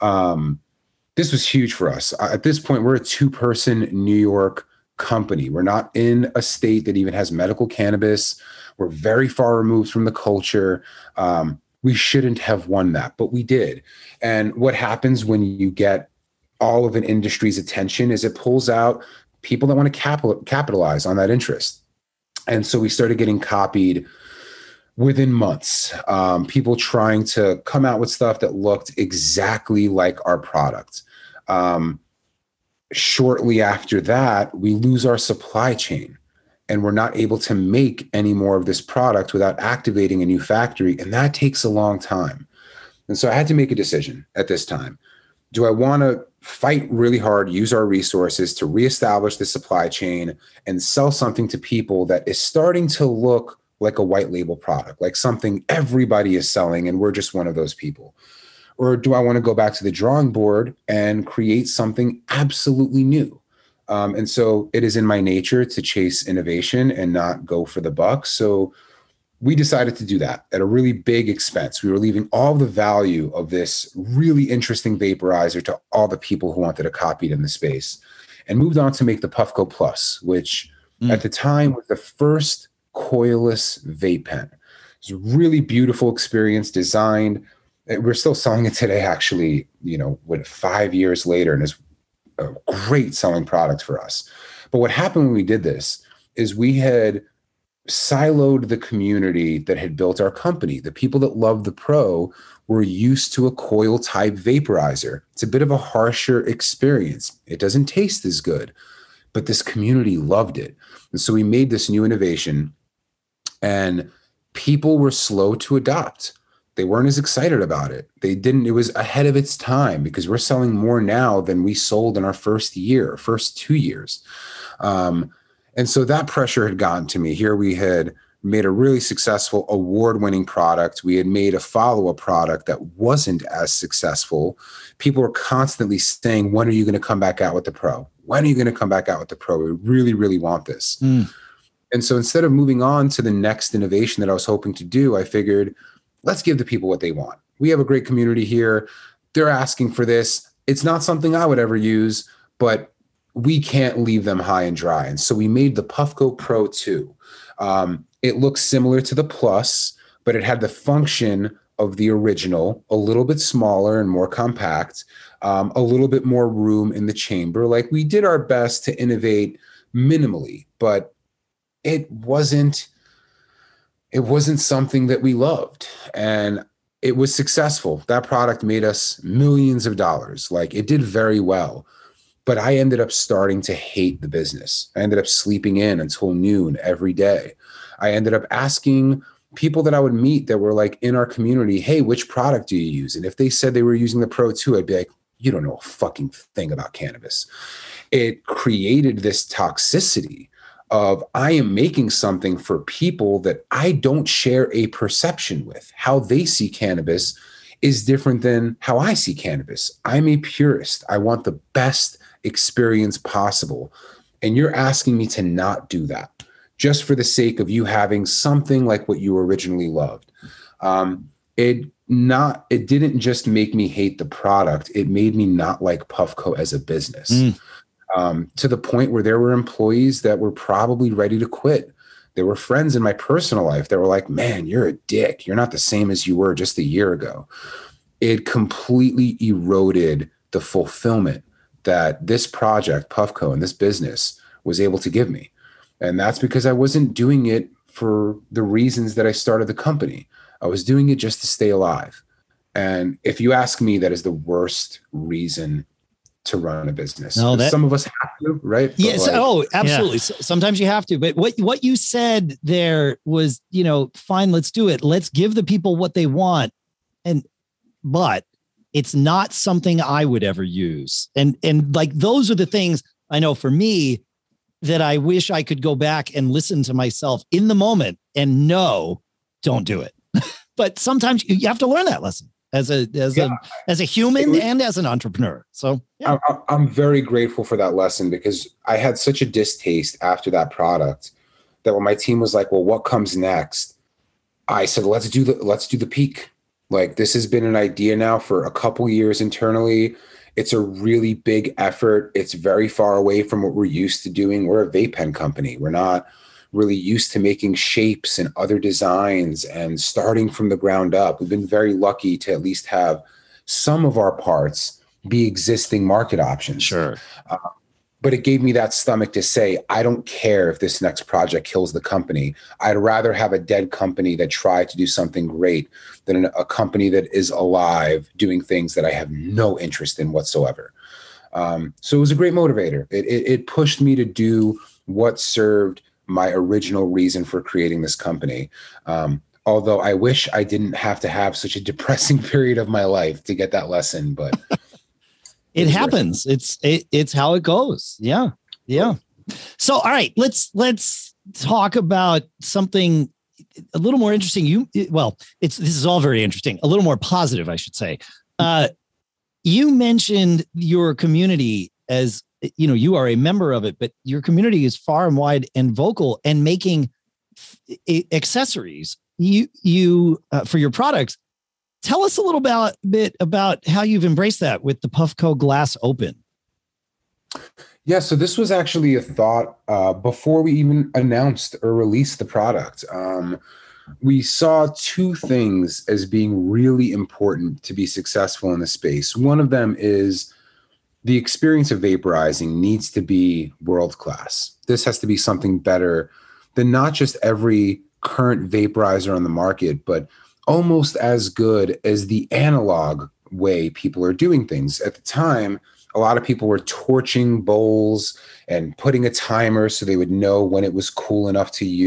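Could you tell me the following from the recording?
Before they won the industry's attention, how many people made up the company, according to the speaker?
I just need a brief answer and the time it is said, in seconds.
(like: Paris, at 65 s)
2, at 3 s.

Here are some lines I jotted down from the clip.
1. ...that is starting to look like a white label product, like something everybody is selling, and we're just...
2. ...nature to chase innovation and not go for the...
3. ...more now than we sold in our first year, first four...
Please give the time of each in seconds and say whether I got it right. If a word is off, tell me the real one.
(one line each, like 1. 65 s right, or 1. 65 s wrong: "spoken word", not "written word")
1. 52 s right
2. 65 s right
3. 120 s wrong: "two", not "four".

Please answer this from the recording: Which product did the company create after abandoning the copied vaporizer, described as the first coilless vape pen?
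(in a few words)
Puffco Plus.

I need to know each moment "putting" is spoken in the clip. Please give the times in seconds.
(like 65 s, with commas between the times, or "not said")
408 s.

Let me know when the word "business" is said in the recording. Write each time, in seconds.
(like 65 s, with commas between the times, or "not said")
184 s, 226 s, 243 s, 256 s.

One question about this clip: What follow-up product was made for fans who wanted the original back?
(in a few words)
Puffco Pro 2.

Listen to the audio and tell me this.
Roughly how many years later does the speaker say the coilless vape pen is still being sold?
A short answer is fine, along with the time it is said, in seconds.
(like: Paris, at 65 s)
5, at 90 s.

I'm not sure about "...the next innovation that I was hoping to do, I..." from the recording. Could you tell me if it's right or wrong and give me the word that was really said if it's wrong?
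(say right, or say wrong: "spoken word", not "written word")
right.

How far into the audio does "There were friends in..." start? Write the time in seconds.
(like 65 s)
232 s.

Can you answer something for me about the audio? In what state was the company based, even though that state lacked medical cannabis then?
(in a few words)
New York.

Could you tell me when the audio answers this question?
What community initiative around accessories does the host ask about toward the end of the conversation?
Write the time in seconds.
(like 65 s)
375 s.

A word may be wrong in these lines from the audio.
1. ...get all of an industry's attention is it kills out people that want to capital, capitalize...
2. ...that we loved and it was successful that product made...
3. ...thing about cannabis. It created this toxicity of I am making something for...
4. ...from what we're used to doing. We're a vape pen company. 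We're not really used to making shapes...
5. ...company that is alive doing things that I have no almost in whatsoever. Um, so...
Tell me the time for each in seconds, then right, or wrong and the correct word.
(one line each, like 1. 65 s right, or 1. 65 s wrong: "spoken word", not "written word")
1. 15 s wrong: "pulls", not "kills"
2. 175 s right
3. 196 s right
4. 303 s right
5. 326 s wrong: "interest", not "almost".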